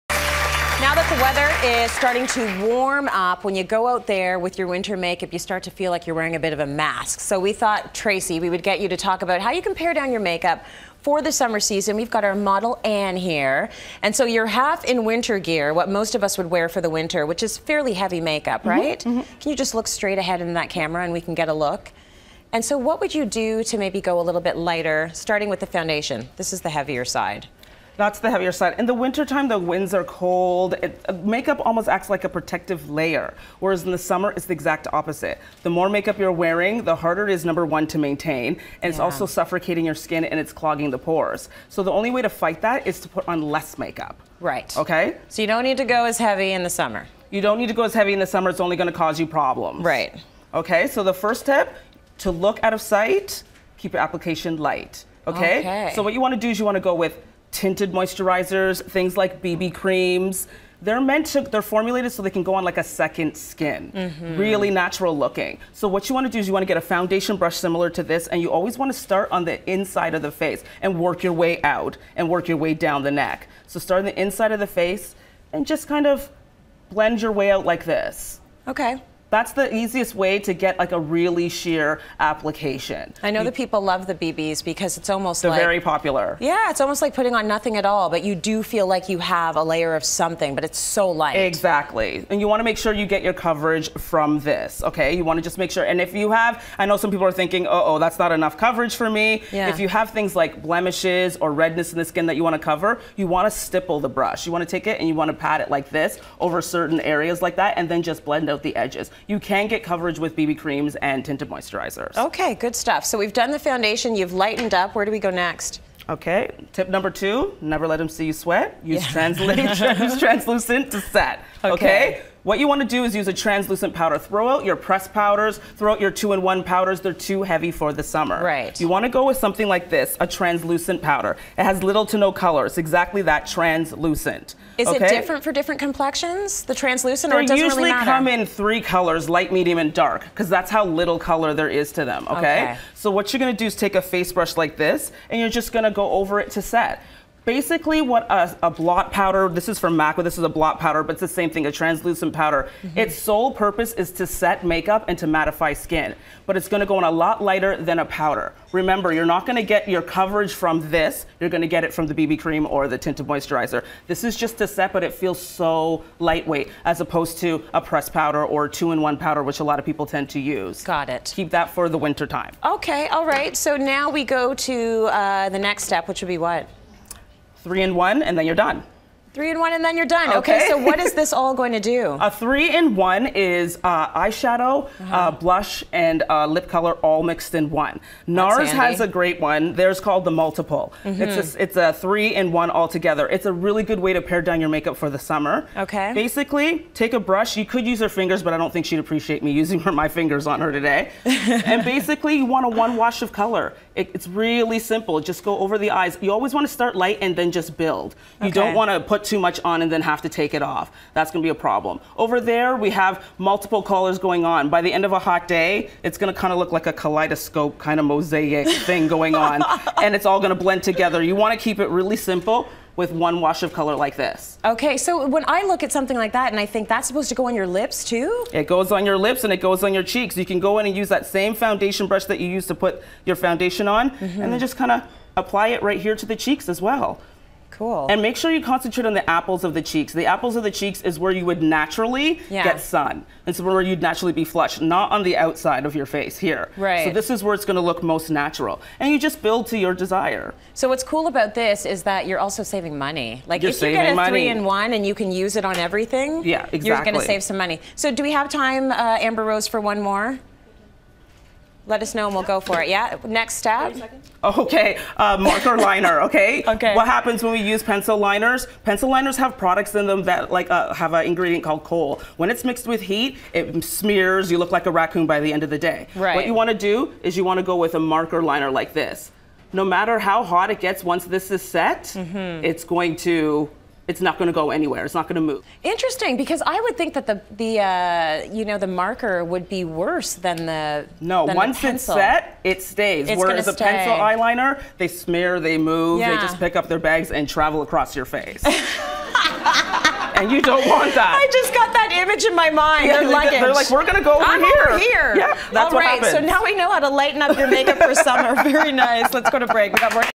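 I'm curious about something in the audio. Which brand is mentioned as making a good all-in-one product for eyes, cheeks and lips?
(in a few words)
NARS.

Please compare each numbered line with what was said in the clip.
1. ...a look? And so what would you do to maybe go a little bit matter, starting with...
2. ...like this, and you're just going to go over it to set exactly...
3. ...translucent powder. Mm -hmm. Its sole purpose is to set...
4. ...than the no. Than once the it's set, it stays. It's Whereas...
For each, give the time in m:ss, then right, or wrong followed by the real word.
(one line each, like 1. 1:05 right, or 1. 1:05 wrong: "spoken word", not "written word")
1. 0:21 wrong: "lighter", not "matter"
2. 2:24 wrong: "basically", not "exactly"
3. 2:31 right
4. 4:50 right.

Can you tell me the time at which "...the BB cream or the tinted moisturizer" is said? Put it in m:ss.
2:42.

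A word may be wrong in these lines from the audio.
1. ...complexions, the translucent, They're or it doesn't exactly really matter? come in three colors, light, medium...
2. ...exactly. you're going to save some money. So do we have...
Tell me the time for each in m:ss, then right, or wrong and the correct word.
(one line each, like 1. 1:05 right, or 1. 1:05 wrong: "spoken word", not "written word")
1. 2:15 wrong: "usually", not "exactly"
2. 4:16 right.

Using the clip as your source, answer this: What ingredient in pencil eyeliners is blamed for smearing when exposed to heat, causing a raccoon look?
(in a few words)
Kohl.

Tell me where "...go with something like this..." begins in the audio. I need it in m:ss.
2:09.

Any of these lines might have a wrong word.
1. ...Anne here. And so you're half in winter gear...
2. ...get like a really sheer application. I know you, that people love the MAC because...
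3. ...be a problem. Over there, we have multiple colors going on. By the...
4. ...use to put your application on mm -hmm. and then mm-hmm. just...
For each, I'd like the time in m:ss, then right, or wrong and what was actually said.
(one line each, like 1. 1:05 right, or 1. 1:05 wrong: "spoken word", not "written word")
1. 0:12 right
2. 1:20 wrong: "BBs", not "MAC"
3. 3:31 right
4. 3:52 wrong: "foundation", not "application".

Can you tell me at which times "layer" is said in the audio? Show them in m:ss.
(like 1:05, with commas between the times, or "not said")
0:32, 1:29.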